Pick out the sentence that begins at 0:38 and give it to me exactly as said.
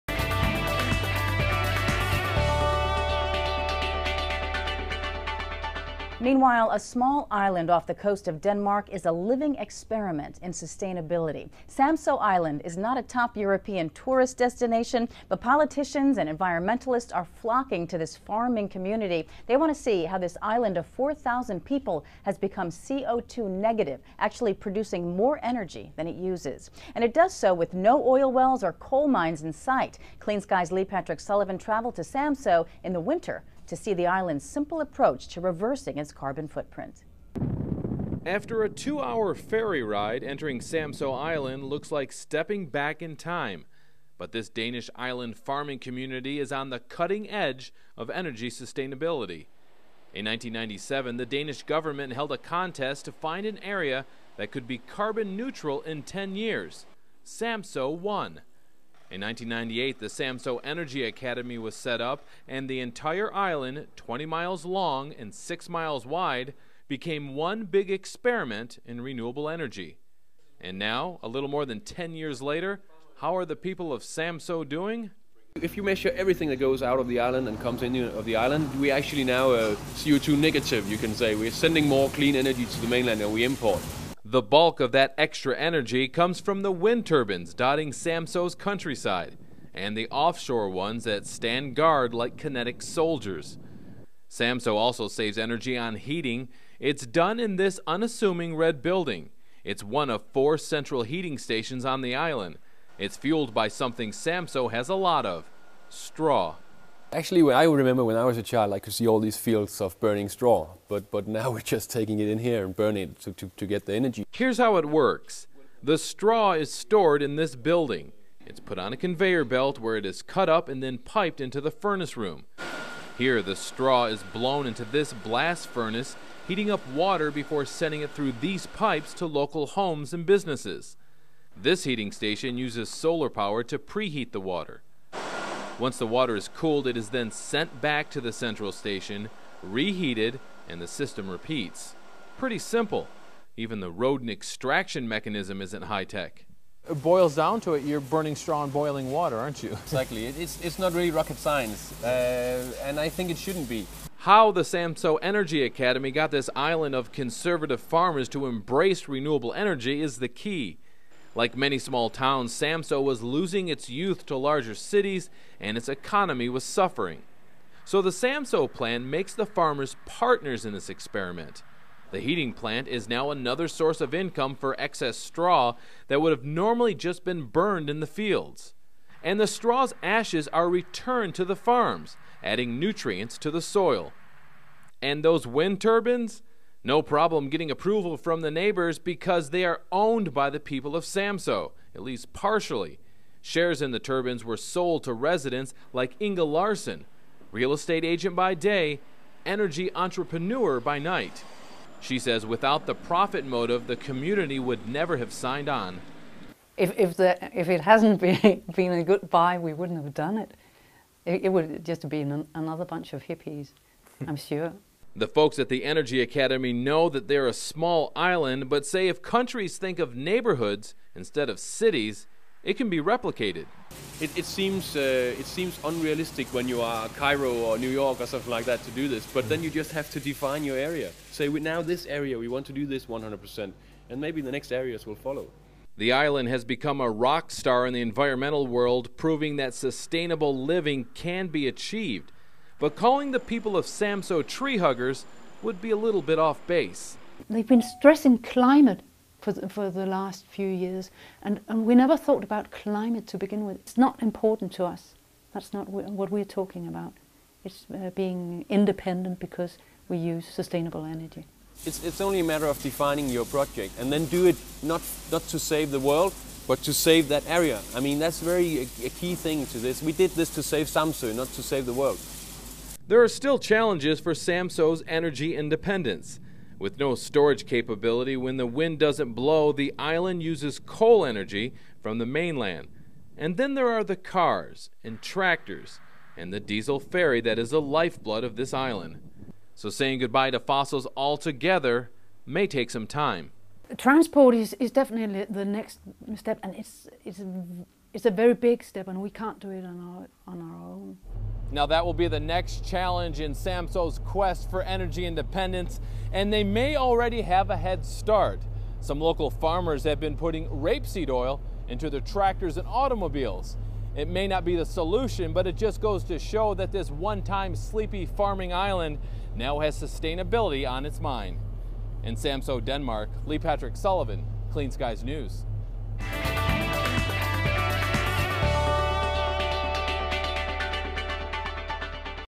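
After a two hour ferry ride, entering Samso Island looks like stepping back in time.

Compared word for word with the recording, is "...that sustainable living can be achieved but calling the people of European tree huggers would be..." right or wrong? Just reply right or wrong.
wrong.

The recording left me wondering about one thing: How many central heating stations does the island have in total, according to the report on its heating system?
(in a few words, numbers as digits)
4.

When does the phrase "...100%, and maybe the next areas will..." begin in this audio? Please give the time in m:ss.
3:53.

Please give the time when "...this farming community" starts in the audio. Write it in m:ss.
0:17.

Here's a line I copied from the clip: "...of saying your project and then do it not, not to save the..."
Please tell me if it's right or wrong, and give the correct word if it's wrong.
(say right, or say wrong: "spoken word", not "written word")
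wrong: "defining", not "saying".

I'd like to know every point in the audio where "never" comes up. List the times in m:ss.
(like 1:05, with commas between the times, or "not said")
3:24, 4:11.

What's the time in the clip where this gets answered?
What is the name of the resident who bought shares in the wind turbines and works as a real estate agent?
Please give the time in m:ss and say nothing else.
3:16.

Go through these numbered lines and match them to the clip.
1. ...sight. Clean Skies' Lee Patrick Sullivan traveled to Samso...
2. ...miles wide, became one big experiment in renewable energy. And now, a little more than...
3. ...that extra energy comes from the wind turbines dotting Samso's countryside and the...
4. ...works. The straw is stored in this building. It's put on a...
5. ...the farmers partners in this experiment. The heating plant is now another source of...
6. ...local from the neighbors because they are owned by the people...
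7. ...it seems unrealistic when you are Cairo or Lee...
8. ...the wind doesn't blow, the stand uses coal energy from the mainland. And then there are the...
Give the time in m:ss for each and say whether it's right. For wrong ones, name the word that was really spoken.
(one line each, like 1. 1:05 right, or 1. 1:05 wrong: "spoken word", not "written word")
1. 0:29 right
2. 1:05 right
3. 1:24 right
4. 1:54 right
5. 2:49 right
6. 3:07 wrong: "approval", not "local"
7. 3:45 wrong: "New", not "Lee"
8. 4:38 wrong: "island", not "stand".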